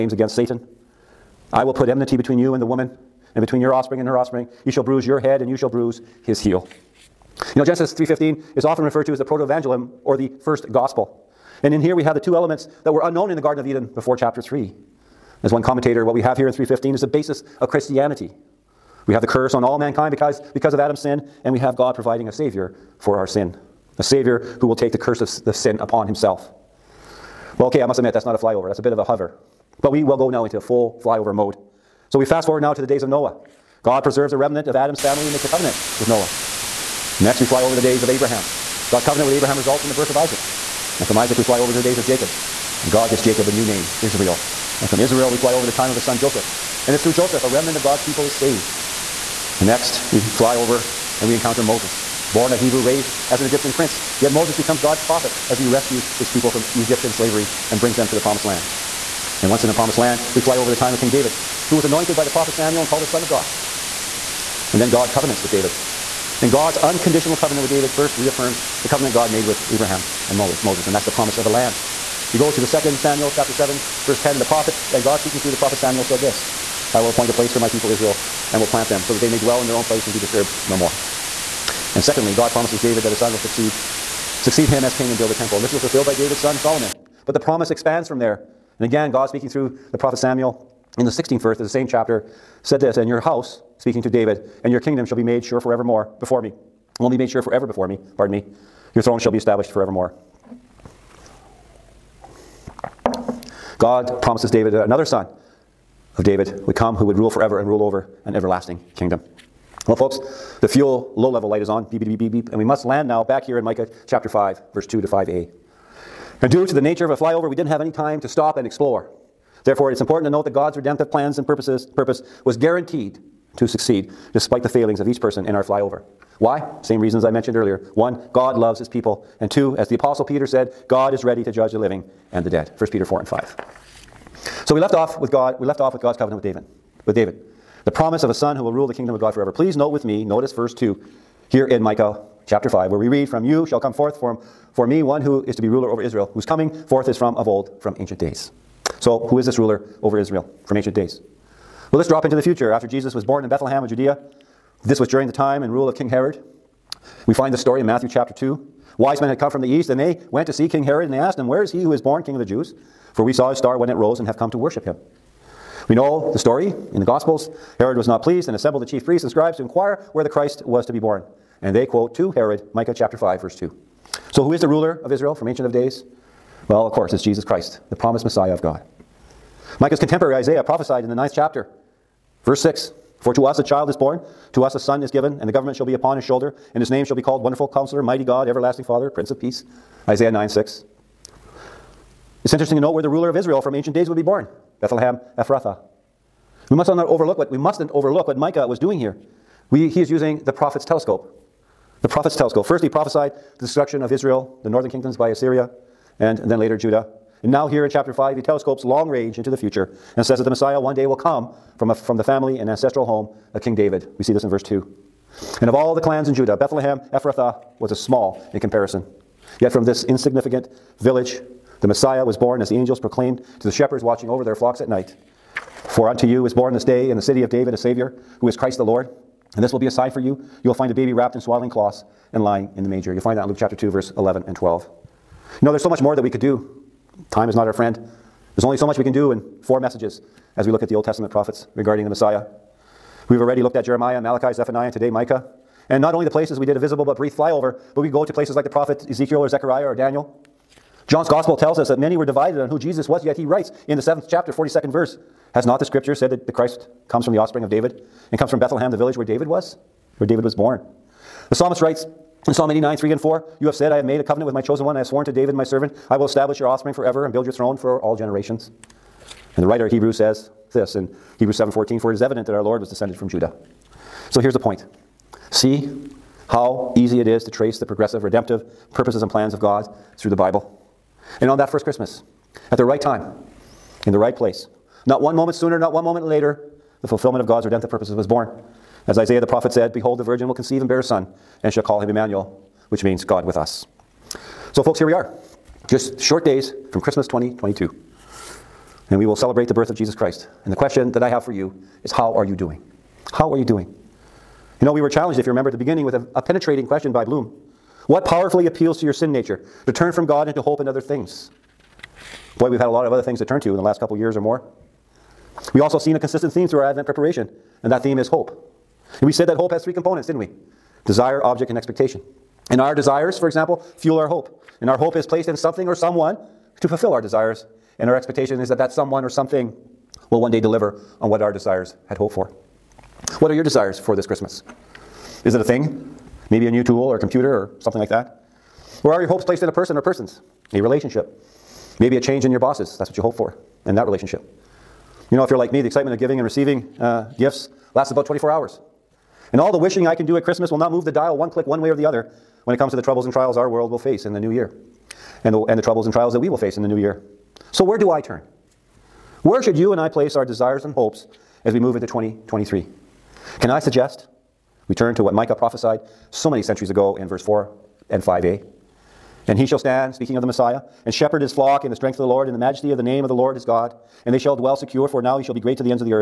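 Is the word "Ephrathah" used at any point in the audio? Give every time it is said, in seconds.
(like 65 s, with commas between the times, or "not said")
195 s, 217 s.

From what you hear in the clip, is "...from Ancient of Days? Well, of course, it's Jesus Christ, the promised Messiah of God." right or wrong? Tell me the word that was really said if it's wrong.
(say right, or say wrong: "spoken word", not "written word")
right.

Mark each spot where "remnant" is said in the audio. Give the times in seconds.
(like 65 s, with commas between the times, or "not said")
34 s, 47 s.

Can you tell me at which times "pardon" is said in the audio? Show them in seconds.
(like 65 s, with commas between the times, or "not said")
98 s.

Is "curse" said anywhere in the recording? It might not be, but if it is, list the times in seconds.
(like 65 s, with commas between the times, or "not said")
19 s, 24 s.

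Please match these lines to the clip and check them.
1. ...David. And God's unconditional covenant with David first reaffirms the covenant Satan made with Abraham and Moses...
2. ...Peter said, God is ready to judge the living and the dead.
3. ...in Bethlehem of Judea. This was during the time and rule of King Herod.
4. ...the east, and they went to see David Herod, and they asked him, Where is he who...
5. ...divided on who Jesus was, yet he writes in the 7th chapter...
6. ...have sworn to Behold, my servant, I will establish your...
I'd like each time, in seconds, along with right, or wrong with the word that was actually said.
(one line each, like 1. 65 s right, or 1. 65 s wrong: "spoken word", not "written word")
1. 65 s wrong: "God", not "Satan"
2. 130 s right
3. 153 s right
4. 159 s wrong: "King", not "David"
5. 252 s right
6. 264 s wrong: "David", not "Behold".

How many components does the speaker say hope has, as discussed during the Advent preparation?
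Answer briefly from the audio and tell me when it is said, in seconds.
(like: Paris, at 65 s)
3, at 319 s.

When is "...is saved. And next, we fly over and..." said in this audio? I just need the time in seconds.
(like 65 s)
48 s.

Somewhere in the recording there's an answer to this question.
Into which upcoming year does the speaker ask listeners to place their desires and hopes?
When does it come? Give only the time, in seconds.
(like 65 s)
362 s.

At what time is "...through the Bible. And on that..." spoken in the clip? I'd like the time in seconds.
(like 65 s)
280 s.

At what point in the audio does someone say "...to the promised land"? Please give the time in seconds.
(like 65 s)
58 s.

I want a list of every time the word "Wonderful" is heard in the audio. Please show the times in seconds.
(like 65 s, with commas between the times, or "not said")
187 s.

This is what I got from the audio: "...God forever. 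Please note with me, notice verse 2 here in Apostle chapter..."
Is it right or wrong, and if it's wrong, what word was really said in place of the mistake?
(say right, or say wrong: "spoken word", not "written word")
wrong: "Micah", not "Apostle".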